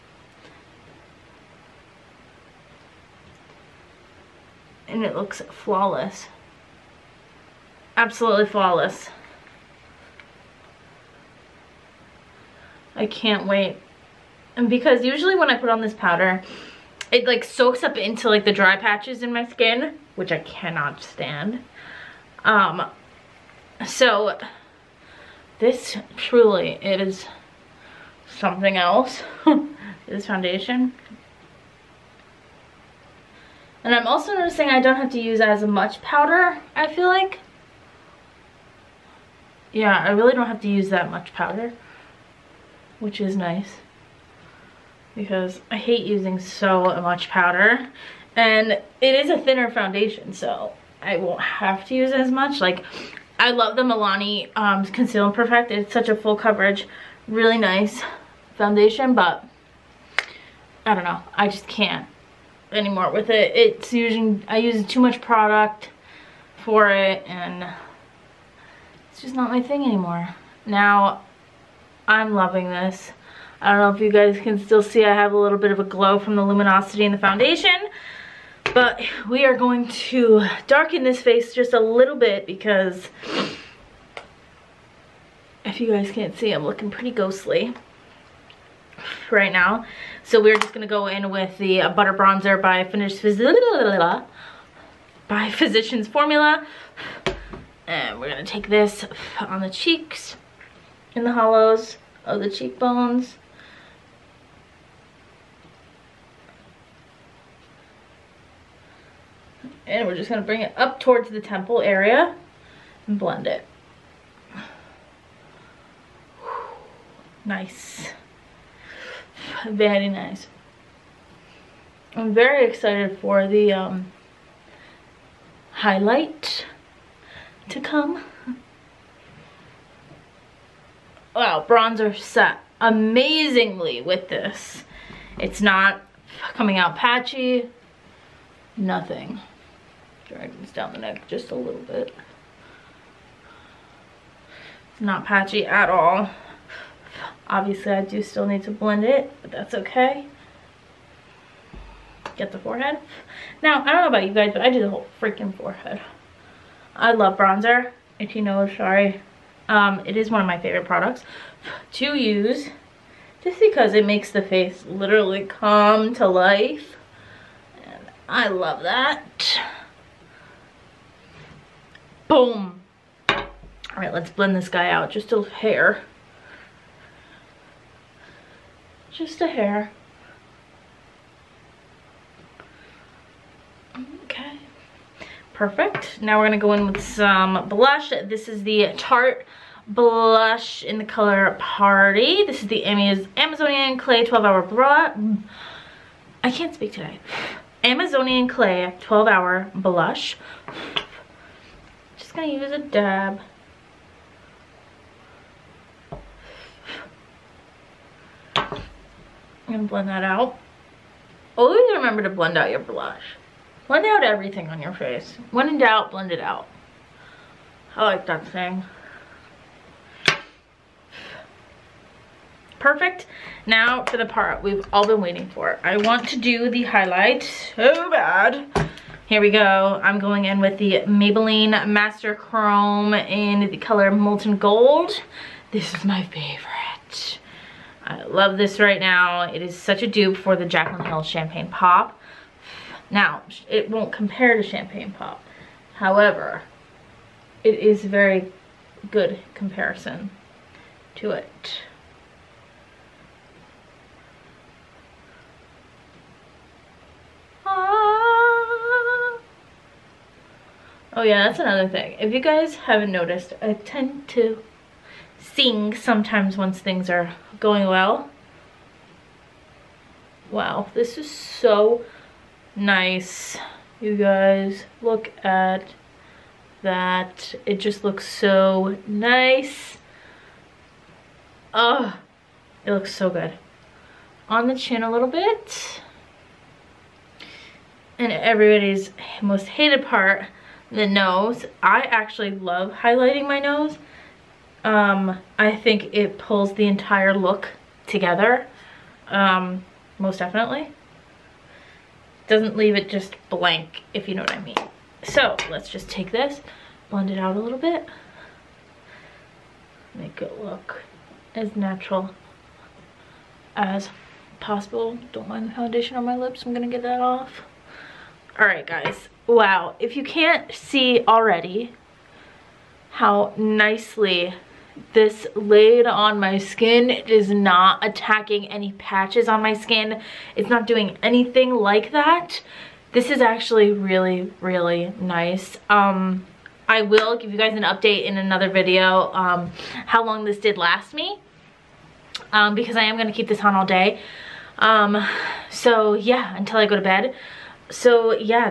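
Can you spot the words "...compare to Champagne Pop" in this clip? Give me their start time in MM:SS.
04:04.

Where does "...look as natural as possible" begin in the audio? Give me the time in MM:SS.
05:10.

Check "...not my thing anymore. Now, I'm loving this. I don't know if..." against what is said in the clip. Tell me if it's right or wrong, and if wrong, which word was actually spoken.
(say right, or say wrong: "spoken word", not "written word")
right.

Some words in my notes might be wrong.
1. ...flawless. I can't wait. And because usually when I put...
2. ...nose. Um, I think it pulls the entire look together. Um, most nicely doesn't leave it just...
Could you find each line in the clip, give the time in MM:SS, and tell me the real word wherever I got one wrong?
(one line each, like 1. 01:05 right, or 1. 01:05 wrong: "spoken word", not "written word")
1. 00:08 right
2. 04:53 wrong: "definitely", not "nicely".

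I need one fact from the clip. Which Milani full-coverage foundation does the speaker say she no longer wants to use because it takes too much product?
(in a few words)
Conceal and Perfect.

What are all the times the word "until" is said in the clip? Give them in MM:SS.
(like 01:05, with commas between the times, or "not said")
05:46.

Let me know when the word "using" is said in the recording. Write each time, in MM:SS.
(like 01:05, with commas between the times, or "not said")
00:46, 01:03.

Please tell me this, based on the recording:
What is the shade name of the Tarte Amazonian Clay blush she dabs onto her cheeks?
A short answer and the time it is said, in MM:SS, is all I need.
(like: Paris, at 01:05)
Party, at 03:11.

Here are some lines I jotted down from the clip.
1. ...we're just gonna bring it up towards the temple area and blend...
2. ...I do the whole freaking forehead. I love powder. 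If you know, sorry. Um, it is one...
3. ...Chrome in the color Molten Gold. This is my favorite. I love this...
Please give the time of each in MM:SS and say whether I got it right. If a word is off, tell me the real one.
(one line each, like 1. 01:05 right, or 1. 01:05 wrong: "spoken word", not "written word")
1. 01:50 right
2. 02:34 wrong: "bronzer", not "powder"
3. 03:52 right.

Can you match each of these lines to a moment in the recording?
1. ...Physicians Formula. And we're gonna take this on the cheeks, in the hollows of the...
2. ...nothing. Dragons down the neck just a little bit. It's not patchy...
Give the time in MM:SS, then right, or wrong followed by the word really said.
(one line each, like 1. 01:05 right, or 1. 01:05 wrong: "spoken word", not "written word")
1. 01:35 right
2. 02:18 right.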